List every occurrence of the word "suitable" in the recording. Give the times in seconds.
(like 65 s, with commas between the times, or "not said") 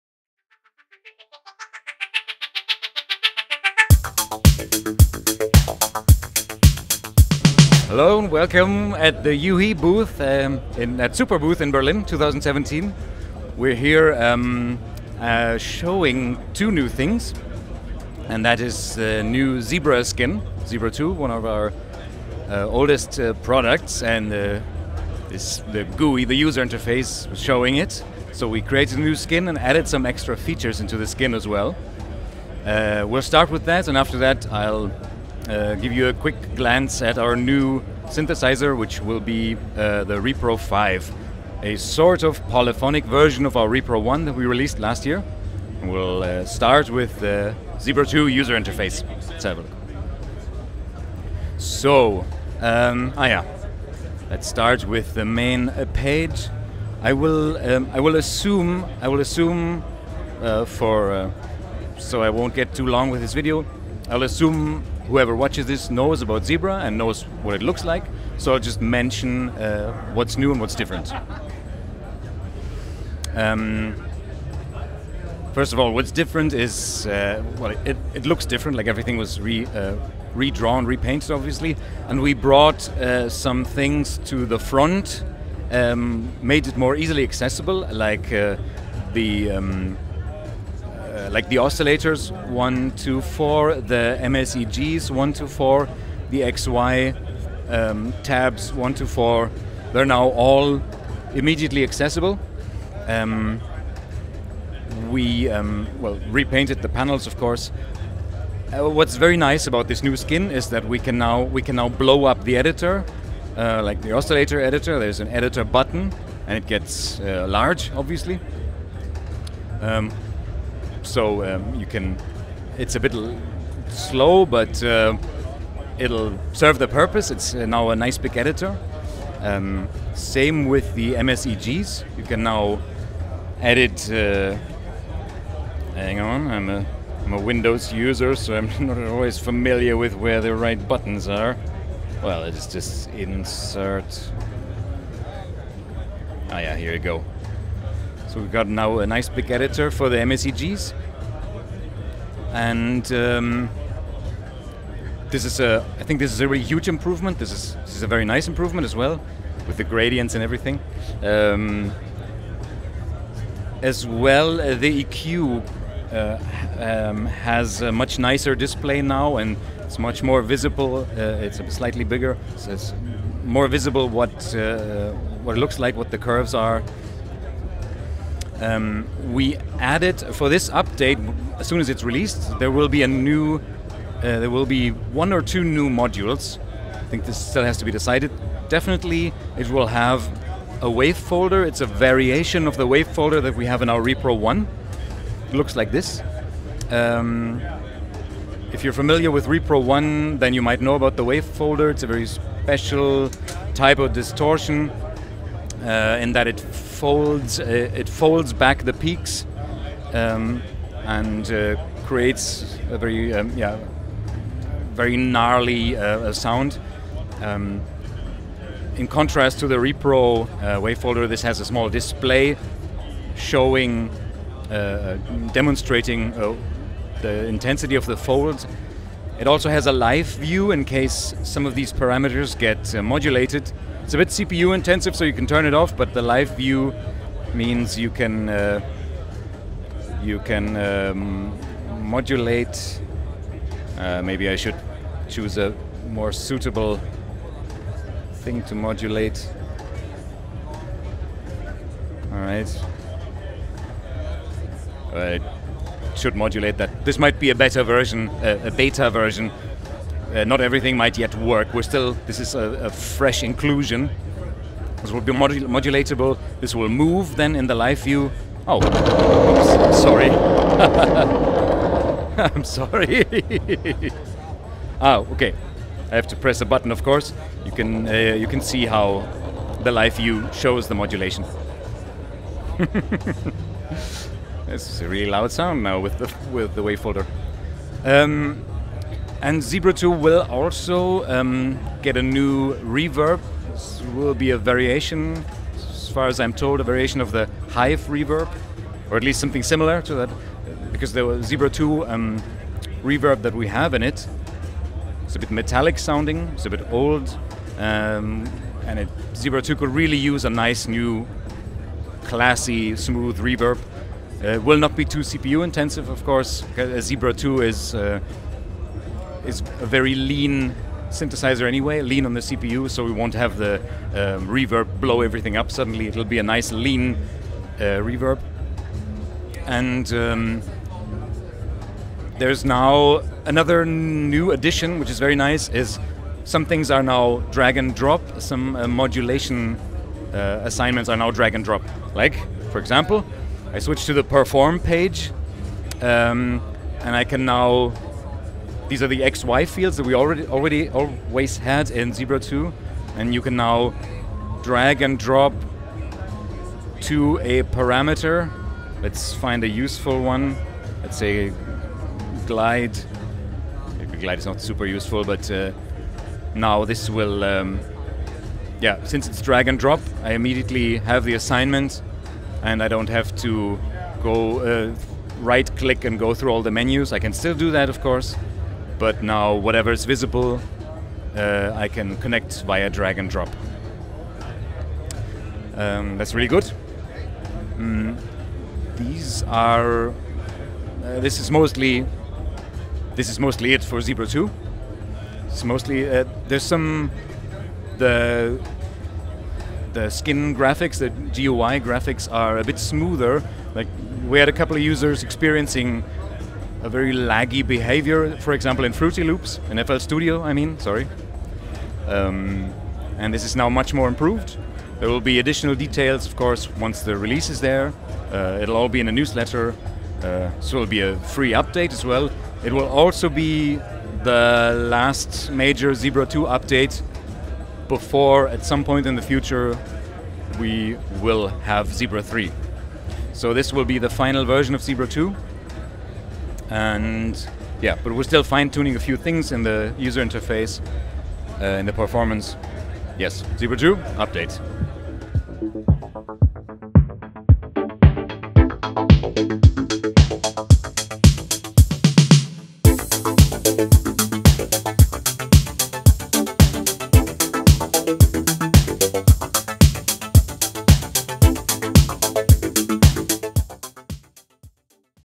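246 s.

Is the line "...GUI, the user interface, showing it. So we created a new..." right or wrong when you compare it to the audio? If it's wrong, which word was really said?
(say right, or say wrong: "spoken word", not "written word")
right.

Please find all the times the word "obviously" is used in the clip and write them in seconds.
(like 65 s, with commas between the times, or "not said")
81 s, 117 s.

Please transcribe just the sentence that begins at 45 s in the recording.
We'll uh, start with the uh, Zebra 2 user interface.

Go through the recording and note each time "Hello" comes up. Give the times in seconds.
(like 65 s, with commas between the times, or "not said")
7 s.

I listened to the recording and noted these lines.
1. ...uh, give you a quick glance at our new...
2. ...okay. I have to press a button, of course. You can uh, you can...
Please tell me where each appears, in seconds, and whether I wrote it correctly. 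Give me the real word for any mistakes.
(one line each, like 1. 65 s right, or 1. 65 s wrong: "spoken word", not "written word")
1. 35 s right
2. 275 s right.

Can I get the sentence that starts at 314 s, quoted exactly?
Uh, it will not be too CPU intensive, of course.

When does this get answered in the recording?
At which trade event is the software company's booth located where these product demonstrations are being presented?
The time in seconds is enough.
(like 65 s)
11 s.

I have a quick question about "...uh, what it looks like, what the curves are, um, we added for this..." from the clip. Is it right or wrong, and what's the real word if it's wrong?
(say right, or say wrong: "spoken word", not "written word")
right.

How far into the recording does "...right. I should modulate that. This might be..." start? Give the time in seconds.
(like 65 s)
252 s.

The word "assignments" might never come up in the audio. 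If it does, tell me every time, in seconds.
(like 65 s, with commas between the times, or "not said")
340 s, 371 s.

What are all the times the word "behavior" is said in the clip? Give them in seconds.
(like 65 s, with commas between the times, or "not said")
407 s.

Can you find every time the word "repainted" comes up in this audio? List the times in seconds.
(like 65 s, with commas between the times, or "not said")
80 s, 106 s.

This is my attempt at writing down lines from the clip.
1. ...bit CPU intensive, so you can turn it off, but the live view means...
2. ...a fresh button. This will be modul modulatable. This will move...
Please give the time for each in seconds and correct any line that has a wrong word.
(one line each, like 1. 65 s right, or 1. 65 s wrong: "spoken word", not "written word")
1. 234 s right
2. 262 s wrong: "inclusion", not "button".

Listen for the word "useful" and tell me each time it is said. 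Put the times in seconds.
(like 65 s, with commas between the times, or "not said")
359 s, 364 s.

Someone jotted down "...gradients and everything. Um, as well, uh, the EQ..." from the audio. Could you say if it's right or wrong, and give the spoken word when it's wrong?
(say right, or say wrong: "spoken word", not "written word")
right.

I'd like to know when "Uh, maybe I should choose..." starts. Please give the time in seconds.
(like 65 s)
243 s.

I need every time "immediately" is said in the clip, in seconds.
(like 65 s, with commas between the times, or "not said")
101 s, 370 s.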